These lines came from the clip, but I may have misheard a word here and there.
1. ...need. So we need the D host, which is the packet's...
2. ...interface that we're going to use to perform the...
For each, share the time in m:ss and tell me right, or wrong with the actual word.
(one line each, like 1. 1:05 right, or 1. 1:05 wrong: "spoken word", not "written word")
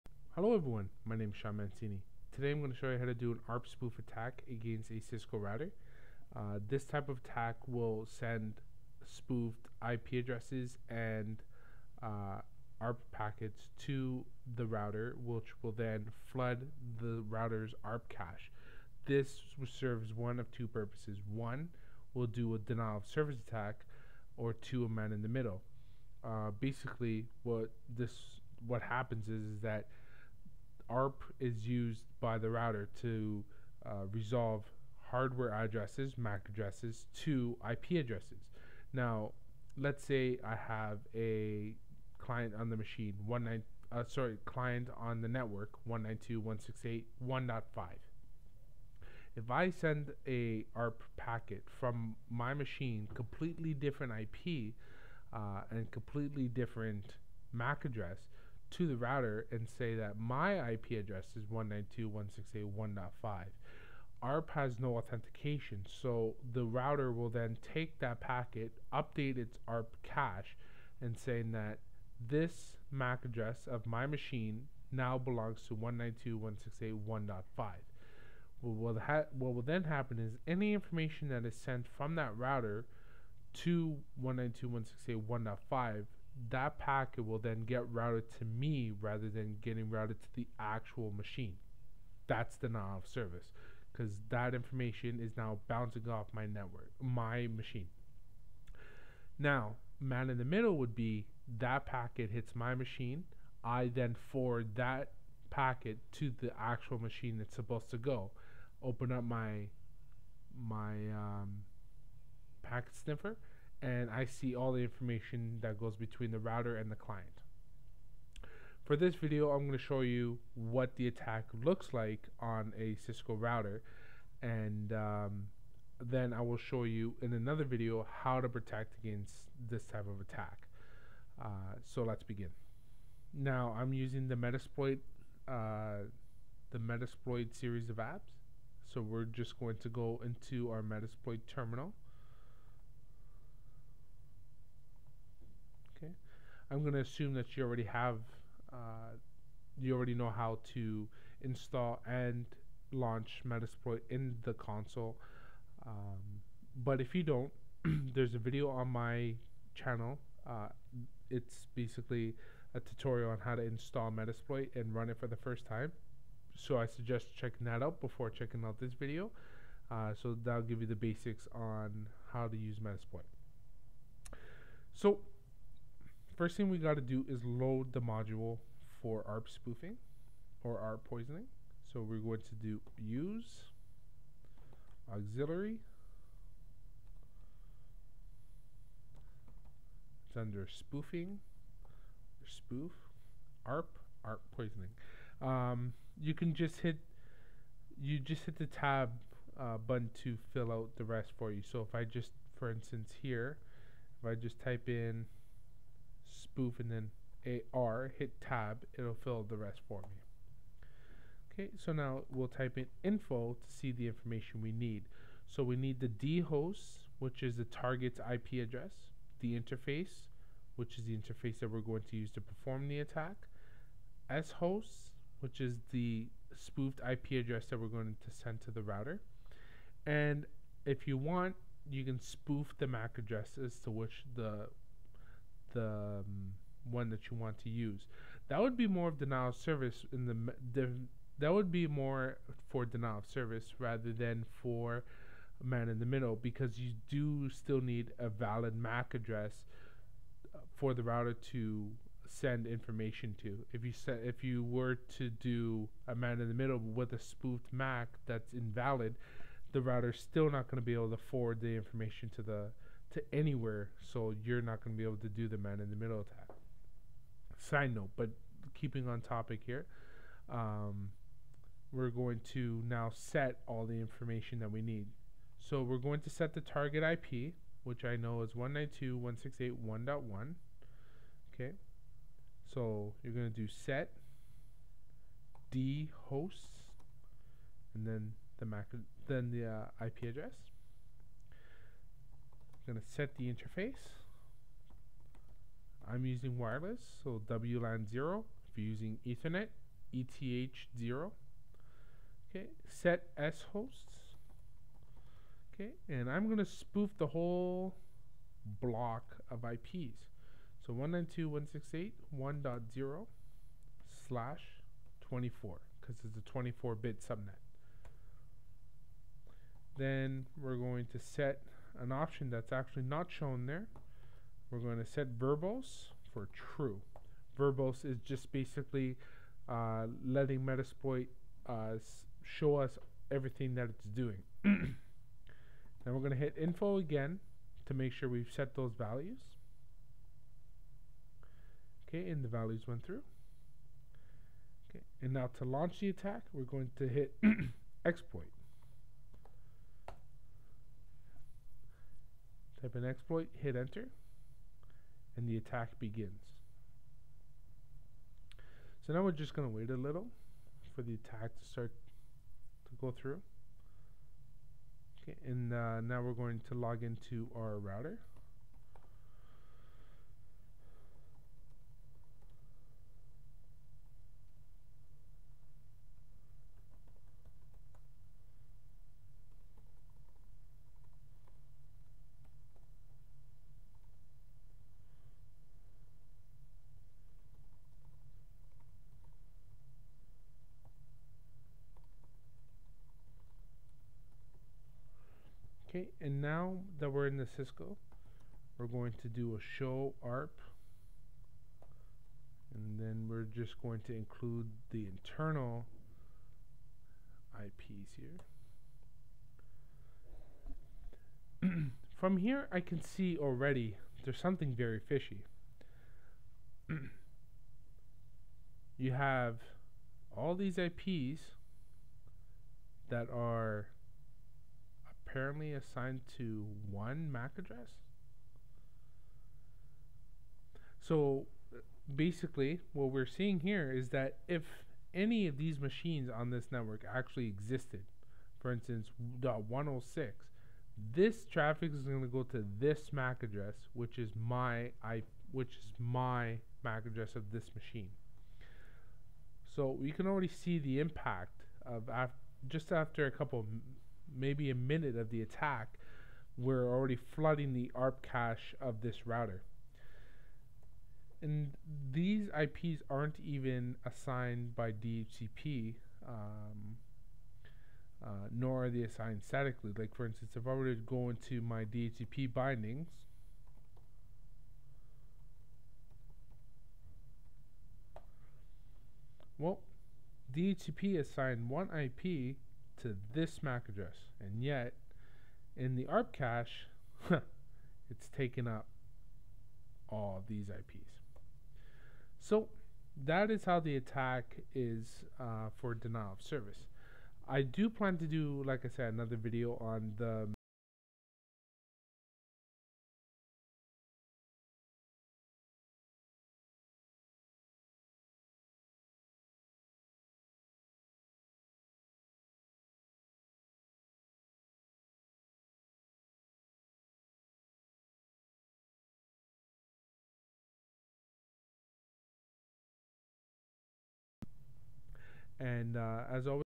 1. 3:34 wrong: "target", not "packet"
2. 3:41 right.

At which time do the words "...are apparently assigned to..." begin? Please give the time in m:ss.
7:03.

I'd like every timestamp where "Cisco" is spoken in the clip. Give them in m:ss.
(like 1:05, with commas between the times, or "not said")
0:04, 2:02, 6:37.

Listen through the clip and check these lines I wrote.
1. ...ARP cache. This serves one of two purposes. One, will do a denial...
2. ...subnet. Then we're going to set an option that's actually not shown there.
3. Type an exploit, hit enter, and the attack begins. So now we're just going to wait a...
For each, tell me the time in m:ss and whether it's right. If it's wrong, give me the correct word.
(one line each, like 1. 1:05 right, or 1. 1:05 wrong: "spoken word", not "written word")
1. 0:17 right
2. 5:17 right
3. 5:52 right.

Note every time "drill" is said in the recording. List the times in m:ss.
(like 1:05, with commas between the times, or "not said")
not said.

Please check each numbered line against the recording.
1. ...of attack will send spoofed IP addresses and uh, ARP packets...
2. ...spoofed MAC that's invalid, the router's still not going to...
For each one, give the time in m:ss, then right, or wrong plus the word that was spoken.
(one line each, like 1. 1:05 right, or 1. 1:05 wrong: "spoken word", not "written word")
1. 0:07 right
2. 4:17 right.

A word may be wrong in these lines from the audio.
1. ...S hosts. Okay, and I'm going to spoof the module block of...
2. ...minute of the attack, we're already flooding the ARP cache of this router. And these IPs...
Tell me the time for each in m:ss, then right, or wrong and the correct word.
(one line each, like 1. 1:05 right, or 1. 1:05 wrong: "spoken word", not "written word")
1. 5:03 wrong: "whole", not "module"
2. 7:34 right.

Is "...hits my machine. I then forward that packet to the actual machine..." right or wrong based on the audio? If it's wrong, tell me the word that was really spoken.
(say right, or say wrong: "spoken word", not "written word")
right.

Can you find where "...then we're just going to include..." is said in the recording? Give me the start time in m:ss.
6:42.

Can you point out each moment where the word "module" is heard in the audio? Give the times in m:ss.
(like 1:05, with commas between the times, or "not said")
2:58.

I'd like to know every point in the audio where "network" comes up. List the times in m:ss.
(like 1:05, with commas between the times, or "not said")
0:45, 1:36, 7:16.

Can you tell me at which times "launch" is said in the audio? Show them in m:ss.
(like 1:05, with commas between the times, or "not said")
2:32, 5:45.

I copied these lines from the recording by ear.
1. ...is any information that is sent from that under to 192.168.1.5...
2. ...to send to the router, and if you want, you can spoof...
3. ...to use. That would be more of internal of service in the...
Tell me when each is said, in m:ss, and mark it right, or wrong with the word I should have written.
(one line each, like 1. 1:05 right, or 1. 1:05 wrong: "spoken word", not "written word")
1. 1:20 wrong: "router", not "under"
2. 3:48 right
3. 3:57 wrong: "denial", not "internal".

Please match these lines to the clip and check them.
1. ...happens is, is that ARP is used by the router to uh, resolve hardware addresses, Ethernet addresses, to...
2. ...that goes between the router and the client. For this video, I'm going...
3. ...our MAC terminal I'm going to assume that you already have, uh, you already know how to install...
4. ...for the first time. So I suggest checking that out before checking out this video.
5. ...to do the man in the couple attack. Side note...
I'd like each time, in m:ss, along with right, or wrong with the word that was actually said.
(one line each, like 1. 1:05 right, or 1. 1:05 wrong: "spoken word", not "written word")
1. 0:28 wrong: "MAC", not "Ethernet"
2. 1:55 right
3. 2:20 wrong: "Metasploit", not "MAC"
4. 2:45 right
5. 4:25 wrong: "middle", not "couple".